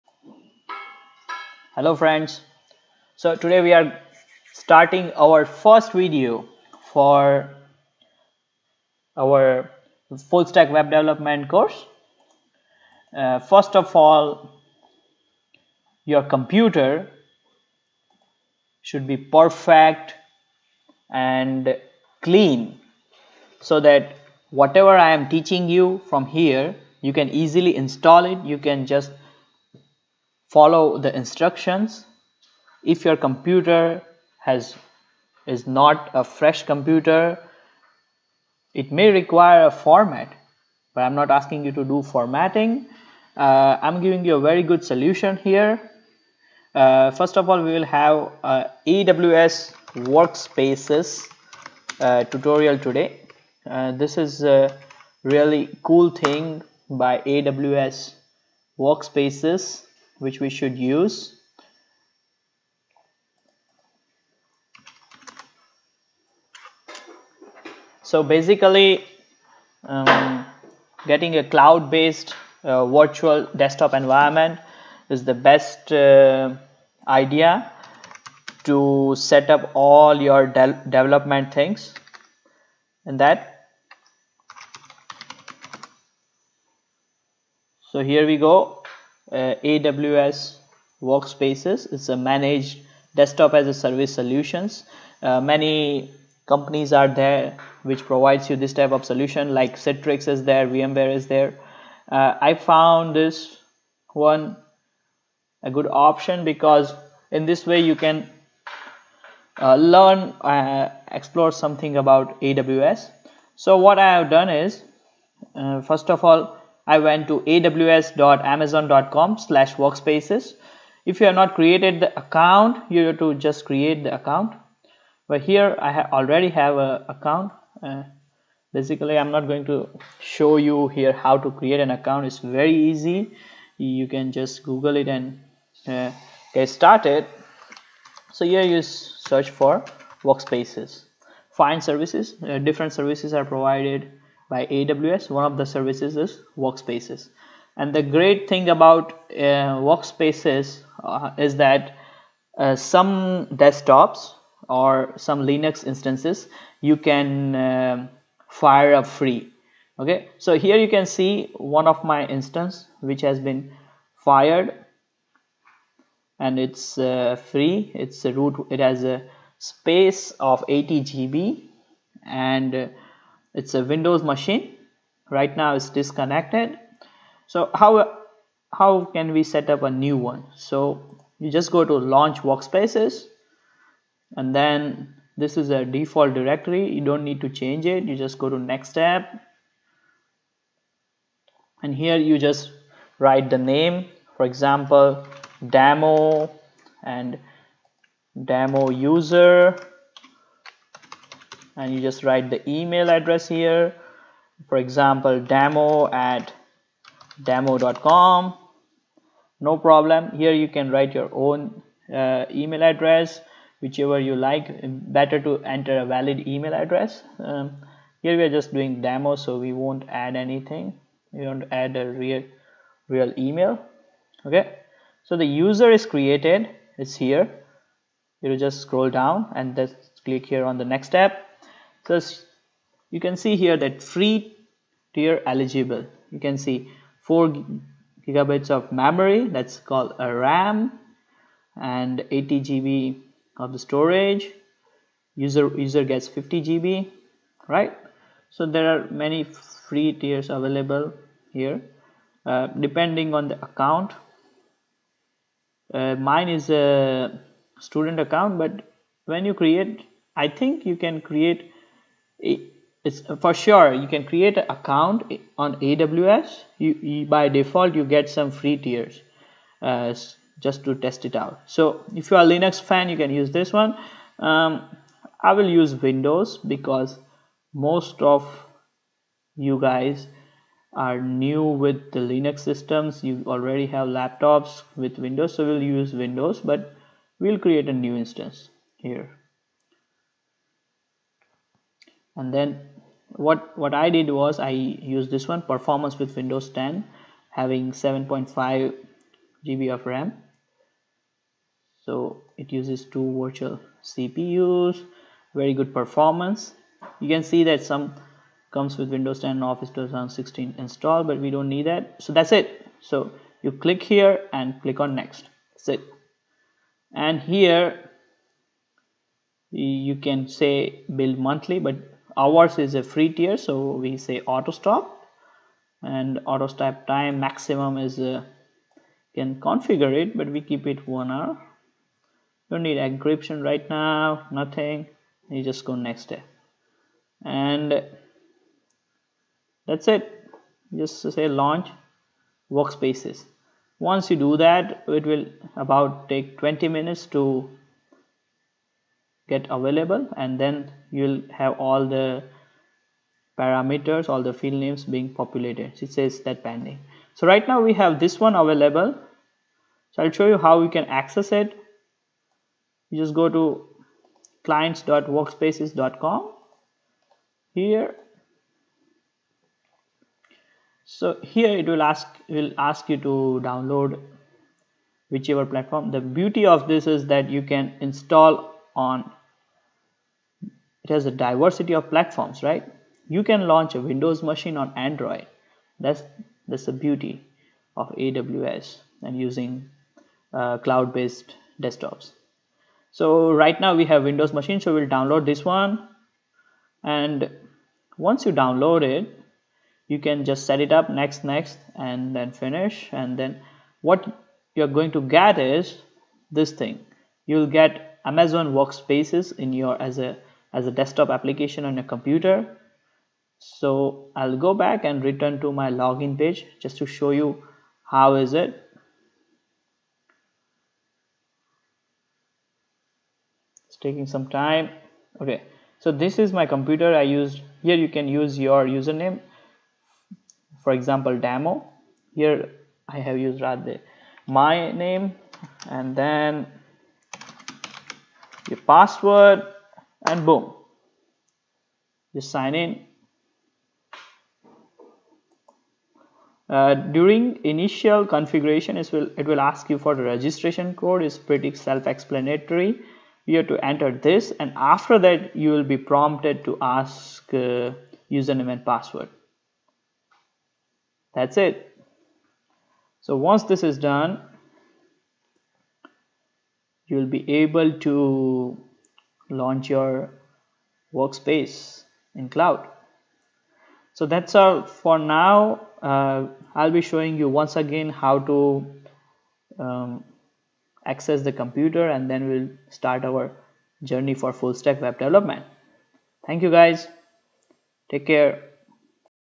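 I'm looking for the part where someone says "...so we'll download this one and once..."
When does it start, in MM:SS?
06:34.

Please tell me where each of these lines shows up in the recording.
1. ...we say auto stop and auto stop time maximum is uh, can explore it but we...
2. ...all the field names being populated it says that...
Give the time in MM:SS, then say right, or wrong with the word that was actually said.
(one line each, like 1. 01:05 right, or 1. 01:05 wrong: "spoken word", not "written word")
1. 05:23 wrong: "configure", not "explore"
2. 05:54 right.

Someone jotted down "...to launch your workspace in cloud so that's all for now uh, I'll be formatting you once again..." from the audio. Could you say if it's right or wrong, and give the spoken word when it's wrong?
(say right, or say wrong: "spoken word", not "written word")
wrong: "showing", not "formatting".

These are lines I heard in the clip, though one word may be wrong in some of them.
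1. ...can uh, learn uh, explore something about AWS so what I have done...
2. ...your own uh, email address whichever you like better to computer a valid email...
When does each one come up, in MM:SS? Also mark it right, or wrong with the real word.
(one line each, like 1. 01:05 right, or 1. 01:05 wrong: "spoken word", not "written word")
1. 01:47 right
2. 03:31 wrong: "enter", not "computer".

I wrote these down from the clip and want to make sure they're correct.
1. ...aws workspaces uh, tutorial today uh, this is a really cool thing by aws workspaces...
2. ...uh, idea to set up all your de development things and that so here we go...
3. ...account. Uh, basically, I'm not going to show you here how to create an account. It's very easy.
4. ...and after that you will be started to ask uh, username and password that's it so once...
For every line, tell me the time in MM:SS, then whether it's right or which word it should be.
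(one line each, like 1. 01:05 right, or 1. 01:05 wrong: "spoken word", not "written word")
1. 00:48 right
2. 01:15 right
3. 02:07 right
4. 07:34 wrong: "prompted", not "started".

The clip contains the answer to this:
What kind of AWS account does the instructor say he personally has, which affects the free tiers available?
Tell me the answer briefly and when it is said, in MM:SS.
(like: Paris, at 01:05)
student account, at 04:17.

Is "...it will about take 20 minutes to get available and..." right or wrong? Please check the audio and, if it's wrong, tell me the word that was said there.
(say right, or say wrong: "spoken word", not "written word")
right.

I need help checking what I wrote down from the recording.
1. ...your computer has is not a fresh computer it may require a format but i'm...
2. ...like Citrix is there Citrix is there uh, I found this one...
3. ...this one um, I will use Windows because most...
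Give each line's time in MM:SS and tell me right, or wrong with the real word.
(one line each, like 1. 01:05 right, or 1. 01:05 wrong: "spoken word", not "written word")
1. 00:33 right
2. 01:39 wrong: "VMware", not "Citrix"
3. 04:33 right.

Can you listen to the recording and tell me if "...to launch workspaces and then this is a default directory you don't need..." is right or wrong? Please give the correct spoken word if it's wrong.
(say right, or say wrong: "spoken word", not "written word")
right.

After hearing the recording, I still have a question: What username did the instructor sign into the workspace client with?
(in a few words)
Radhey.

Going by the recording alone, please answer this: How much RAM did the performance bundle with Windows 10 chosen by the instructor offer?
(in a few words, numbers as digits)
7.5 GB.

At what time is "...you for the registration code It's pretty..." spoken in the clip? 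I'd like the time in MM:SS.
07:29.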